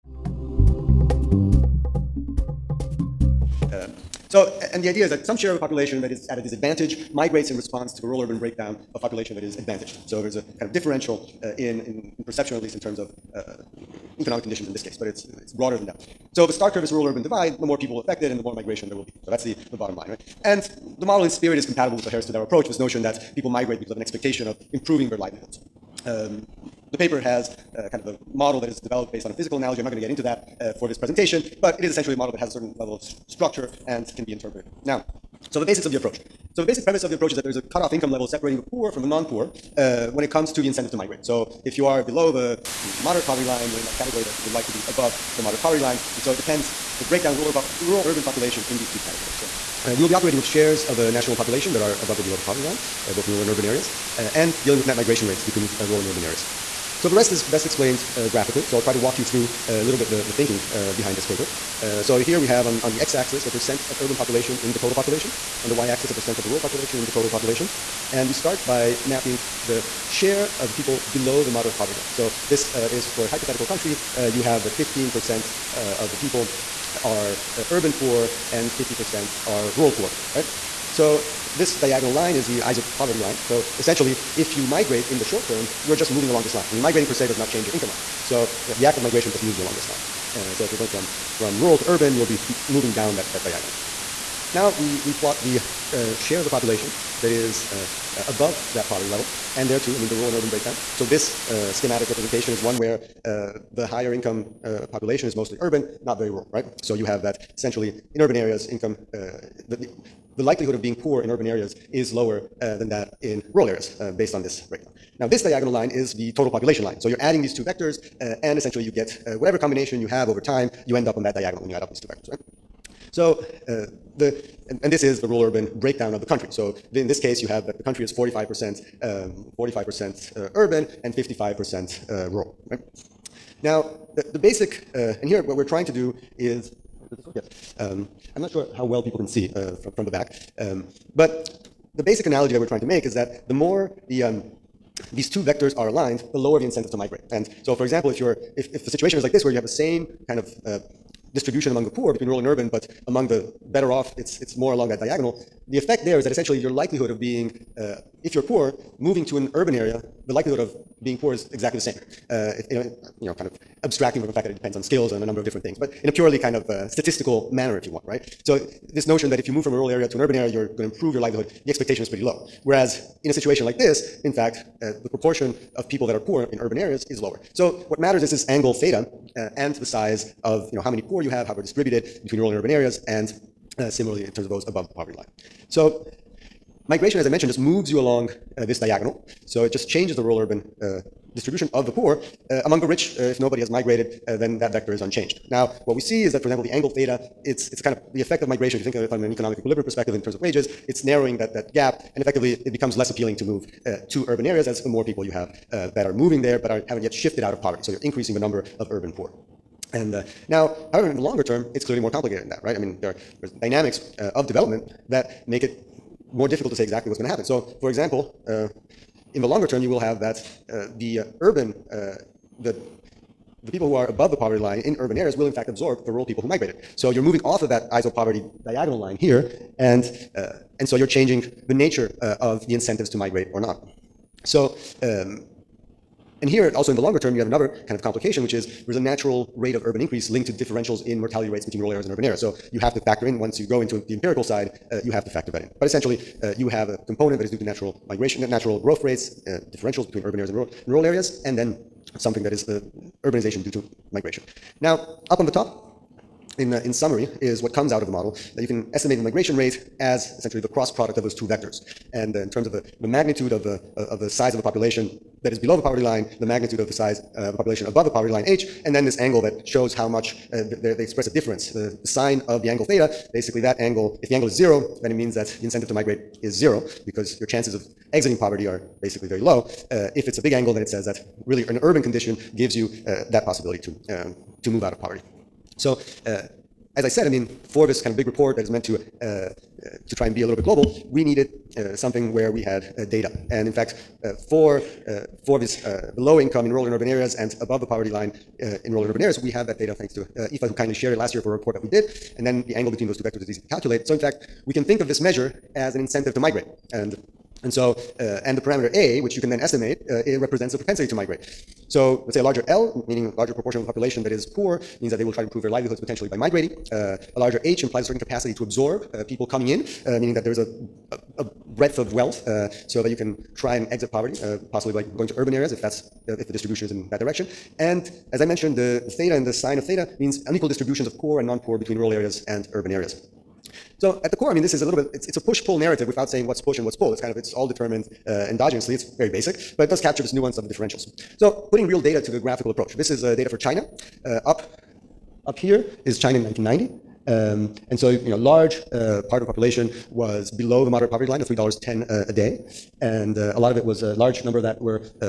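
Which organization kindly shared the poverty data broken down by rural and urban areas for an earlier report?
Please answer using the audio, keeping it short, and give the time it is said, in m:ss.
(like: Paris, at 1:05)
IFA, at 5:00.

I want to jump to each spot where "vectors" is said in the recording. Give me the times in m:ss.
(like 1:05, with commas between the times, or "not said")
1:57, 2:02, 2:25, 3:14, 4:21, 5:03.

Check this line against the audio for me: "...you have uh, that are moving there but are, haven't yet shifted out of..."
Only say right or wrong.
right.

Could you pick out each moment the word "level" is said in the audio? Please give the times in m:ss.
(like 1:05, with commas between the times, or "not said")
0:32, 0:38, 1:27, 1:39.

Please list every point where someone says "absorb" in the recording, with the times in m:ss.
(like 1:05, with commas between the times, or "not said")
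3:45, 5:18.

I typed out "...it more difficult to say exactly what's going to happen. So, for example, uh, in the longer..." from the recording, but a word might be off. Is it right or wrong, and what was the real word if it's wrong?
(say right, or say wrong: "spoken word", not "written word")
right.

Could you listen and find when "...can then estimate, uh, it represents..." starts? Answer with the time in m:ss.
5:09.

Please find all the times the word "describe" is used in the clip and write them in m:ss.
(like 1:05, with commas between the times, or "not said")
not said.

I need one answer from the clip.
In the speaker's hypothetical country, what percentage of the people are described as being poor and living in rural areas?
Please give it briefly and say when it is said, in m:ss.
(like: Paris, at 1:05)
50%, at 1:18.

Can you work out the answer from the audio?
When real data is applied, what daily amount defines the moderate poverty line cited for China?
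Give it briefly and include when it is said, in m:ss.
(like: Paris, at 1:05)
$3.10, at 5:51.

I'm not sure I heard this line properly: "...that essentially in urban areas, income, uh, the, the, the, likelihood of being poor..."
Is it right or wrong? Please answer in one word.
right.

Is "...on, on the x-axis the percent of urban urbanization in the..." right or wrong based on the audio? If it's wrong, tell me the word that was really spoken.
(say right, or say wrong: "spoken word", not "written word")
wrong: "population", not "urbanization".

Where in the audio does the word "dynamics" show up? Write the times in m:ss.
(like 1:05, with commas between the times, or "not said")
3:33.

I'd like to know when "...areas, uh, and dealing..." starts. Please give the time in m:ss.
0:53.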